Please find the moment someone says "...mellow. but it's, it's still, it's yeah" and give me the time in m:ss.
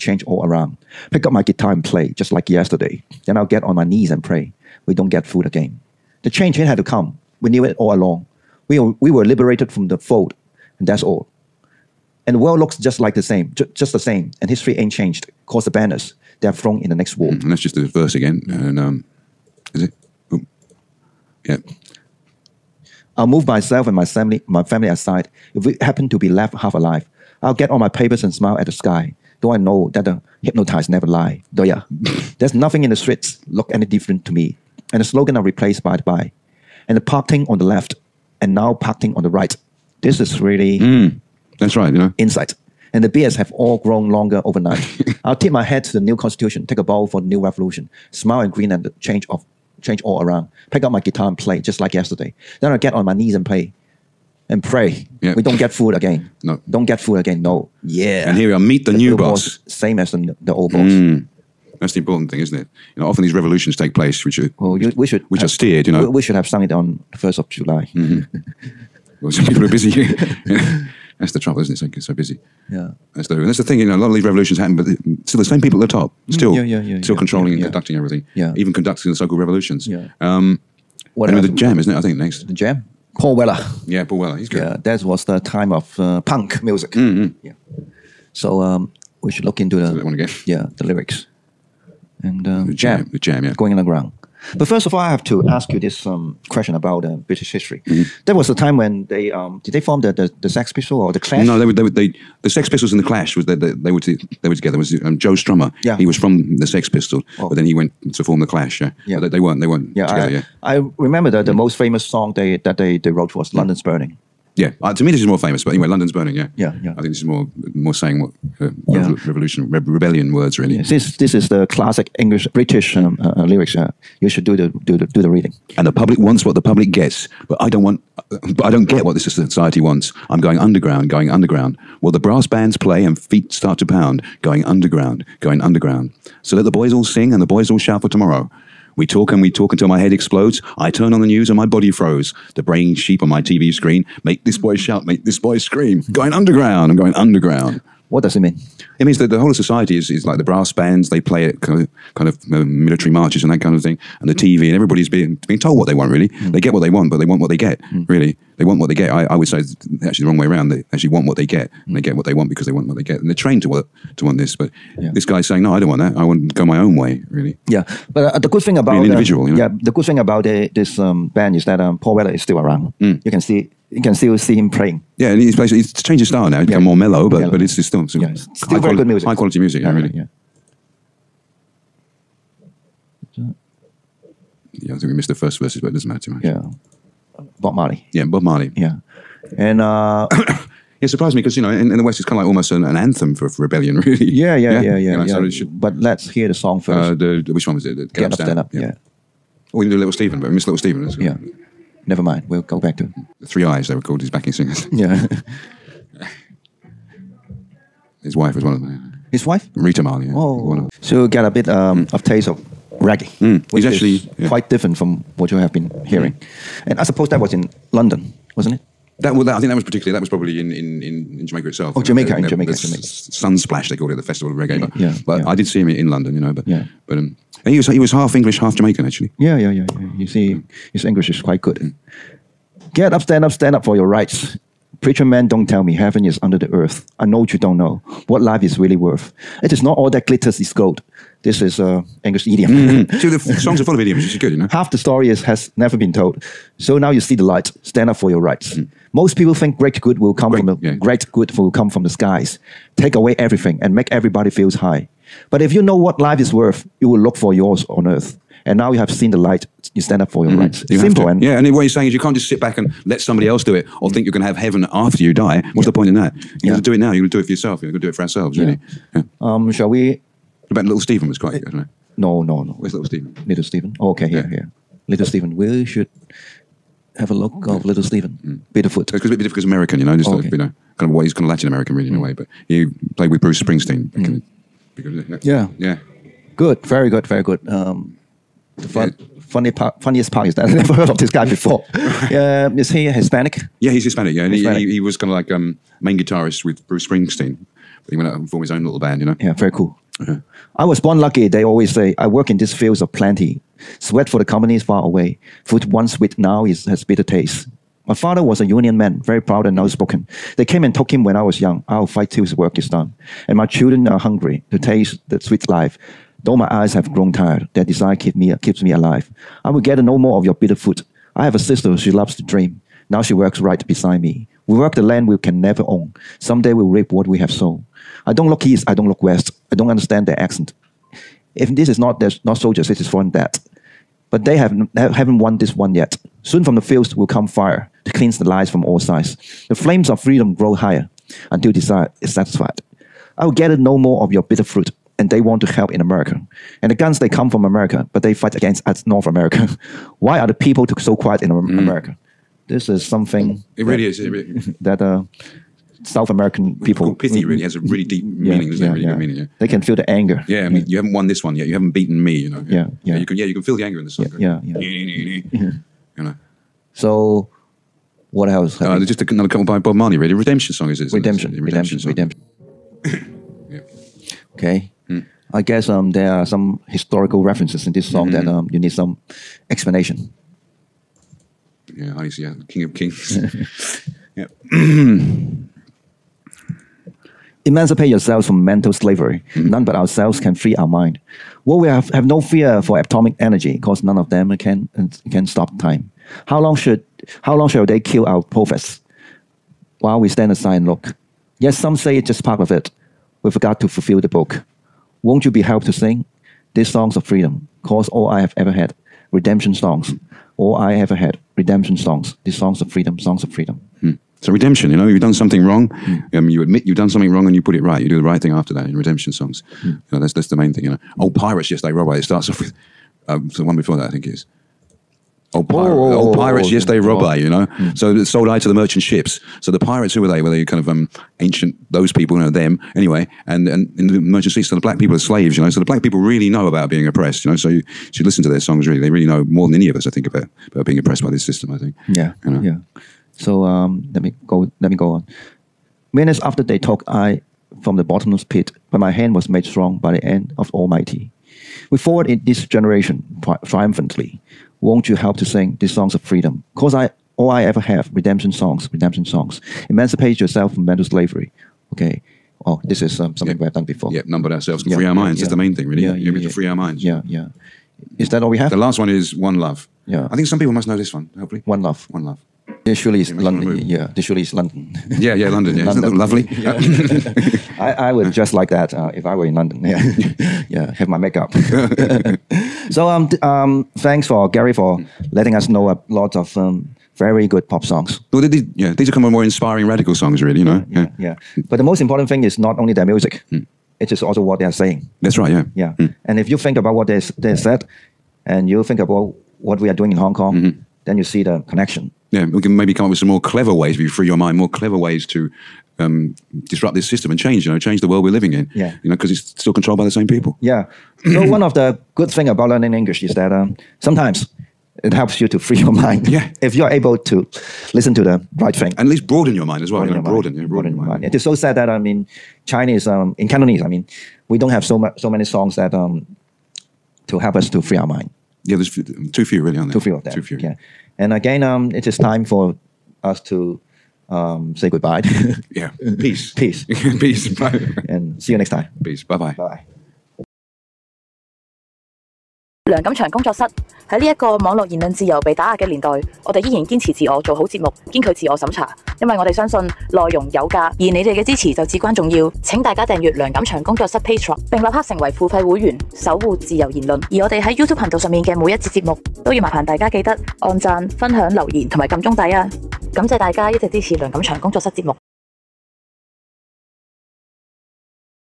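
2:57.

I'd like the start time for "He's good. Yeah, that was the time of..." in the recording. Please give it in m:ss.
1:24.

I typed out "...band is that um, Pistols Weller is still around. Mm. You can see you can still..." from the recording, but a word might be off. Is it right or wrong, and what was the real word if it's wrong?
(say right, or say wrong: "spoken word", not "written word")
wrong: "Paul", not "Pistols".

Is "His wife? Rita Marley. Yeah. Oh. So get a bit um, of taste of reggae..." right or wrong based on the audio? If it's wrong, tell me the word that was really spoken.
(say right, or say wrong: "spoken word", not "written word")
right.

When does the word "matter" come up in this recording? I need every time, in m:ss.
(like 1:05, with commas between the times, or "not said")
3:06.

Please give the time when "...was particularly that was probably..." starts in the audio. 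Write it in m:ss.
3:39.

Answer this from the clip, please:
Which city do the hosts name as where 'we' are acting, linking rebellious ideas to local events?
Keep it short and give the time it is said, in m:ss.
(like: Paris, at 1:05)
Hong Kong, at 8:20.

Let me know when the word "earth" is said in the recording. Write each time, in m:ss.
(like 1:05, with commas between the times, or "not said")
3:56, 4:18.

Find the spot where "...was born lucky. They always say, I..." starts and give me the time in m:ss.
5:00.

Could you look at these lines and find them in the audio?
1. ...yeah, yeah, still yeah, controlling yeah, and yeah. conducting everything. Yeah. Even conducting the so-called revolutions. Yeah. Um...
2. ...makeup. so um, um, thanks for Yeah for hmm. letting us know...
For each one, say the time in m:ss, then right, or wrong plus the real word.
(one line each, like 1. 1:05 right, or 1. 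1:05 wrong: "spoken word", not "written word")
1. 1:16 right
2. 8:01 wrong: "Gary", not "Yeah".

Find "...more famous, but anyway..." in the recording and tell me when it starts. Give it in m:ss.
1:55.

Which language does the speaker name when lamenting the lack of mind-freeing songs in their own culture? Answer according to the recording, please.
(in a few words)
Cantonese.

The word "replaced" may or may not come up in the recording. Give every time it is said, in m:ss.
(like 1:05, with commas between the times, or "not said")
0:35.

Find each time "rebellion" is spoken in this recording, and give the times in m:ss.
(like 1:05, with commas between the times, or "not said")
1:59, 3:13.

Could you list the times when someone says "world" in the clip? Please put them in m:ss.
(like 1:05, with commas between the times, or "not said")
0:12, 8:28.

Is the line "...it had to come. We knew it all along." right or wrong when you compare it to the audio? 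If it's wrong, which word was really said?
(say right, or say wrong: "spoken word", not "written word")
right.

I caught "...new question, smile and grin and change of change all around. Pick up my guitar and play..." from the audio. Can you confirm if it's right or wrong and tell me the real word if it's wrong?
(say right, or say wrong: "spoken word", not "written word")
wrong: "revolution", not "question".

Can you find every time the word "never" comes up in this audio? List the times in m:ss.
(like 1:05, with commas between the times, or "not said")
0:30, 3:22, 4:05, 4:50, 5:25.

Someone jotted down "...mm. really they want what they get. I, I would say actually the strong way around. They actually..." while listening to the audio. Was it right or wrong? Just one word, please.
wrong.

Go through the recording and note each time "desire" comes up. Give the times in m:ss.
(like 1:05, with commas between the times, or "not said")
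5:17, 5:41.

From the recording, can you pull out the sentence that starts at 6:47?
Cause all I have ever had redemption songs.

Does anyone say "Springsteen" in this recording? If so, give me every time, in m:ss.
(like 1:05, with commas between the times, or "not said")
4:43, 4:57.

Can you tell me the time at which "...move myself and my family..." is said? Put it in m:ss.
0:23.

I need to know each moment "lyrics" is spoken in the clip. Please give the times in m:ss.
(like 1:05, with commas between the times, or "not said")
1:30, 2:03.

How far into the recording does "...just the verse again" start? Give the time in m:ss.
0:17.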